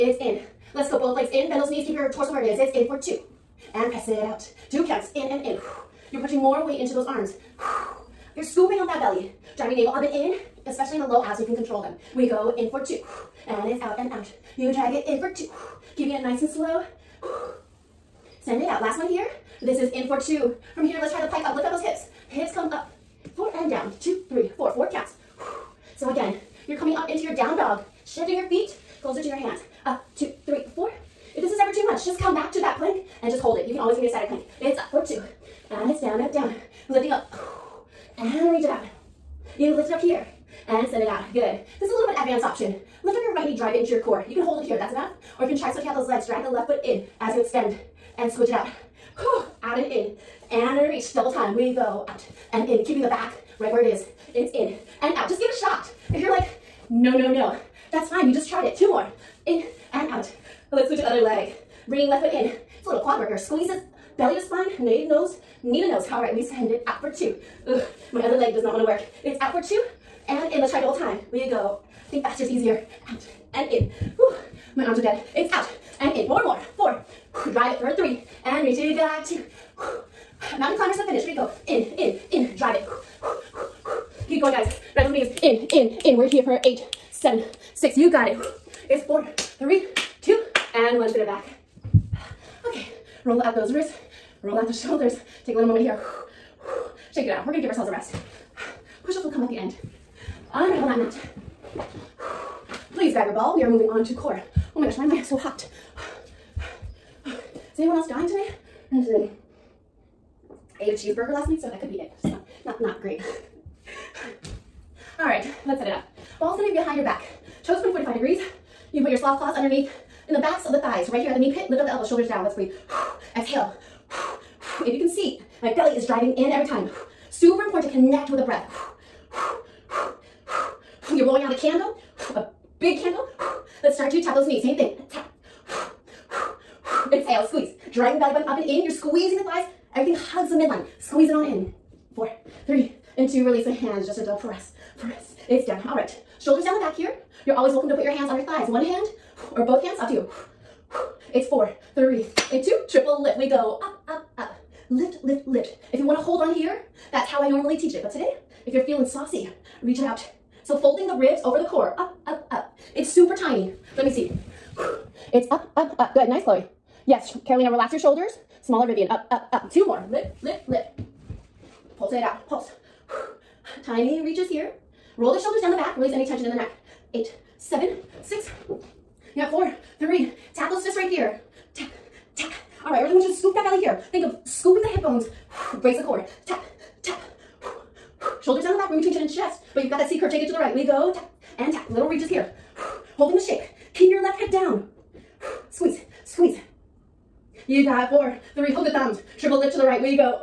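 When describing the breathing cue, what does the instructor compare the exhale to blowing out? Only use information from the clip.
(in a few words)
A big candle.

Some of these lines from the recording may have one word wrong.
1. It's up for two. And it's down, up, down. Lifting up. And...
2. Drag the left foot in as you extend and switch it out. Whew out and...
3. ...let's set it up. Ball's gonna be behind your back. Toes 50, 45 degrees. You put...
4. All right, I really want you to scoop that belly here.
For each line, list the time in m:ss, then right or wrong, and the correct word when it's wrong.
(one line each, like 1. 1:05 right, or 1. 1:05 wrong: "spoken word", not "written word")
1. 0:34 right
2. 0:46 right
3. 1:55 wrong: "20", not "50"
4. 3:02 right.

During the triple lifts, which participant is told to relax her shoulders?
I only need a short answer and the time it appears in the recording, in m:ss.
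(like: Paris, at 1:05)
Carolina, at 2:47.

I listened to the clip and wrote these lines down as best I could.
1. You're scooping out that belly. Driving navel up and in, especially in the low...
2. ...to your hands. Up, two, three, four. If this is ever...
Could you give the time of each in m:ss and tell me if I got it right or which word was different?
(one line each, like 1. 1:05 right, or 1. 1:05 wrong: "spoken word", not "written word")
1. 0:08 right
2. 0:29 right.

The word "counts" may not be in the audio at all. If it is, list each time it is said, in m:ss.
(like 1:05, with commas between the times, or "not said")
0:04, 0:24.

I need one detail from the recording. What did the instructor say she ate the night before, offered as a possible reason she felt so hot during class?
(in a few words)
A cheeseburger.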